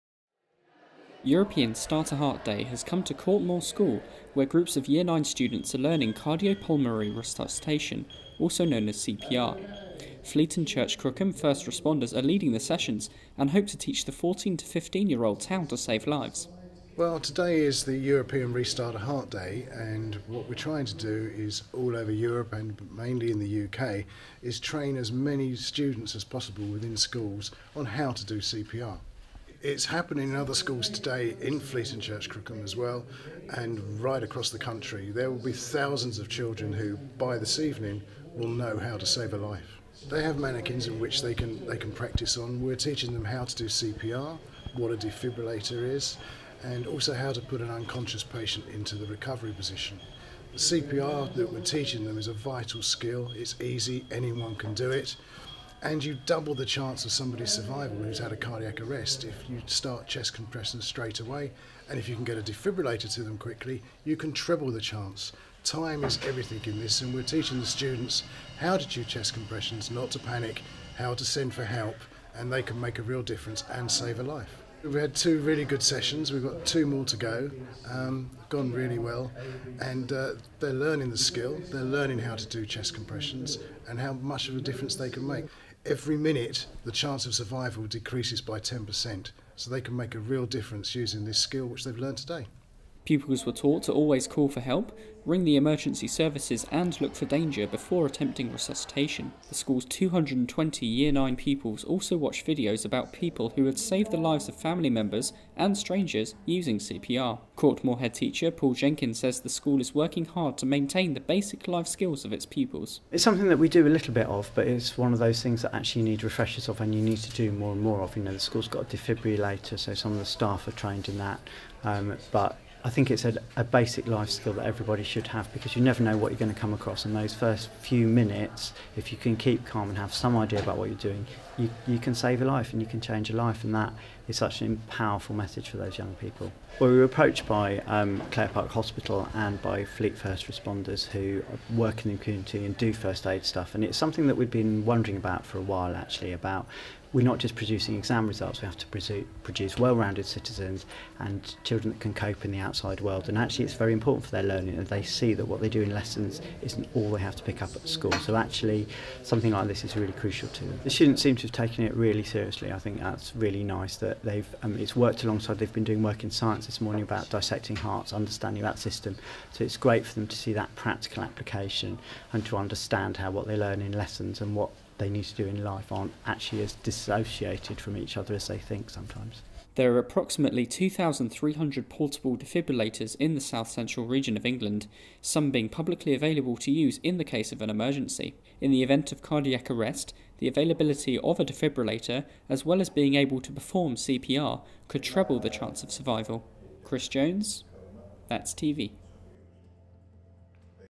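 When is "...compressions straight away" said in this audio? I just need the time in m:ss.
1:00.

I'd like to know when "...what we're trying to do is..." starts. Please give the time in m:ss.
0:20.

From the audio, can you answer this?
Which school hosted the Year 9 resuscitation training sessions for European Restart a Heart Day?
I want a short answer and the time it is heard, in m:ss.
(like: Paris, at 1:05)
Court Moor School, at 0:03.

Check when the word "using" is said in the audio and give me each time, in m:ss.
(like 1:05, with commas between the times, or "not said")
1:30, 1:46.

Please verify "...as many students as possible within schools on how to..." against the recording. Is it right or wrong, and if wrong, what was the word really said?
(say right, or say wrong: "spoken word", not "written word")
right.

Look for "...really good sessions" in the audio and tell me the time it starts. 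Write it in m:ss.
1:15.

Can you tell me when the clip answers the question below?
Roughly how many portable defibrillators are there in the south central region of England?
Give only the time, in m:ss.
3:00.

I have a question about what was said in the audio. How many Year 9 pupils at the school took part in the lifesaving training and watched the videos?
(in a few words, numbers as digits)
220.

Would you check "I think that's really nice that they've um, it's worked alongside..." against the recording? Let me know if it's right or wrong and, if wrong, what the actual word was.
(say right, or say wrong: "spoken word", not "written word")
right.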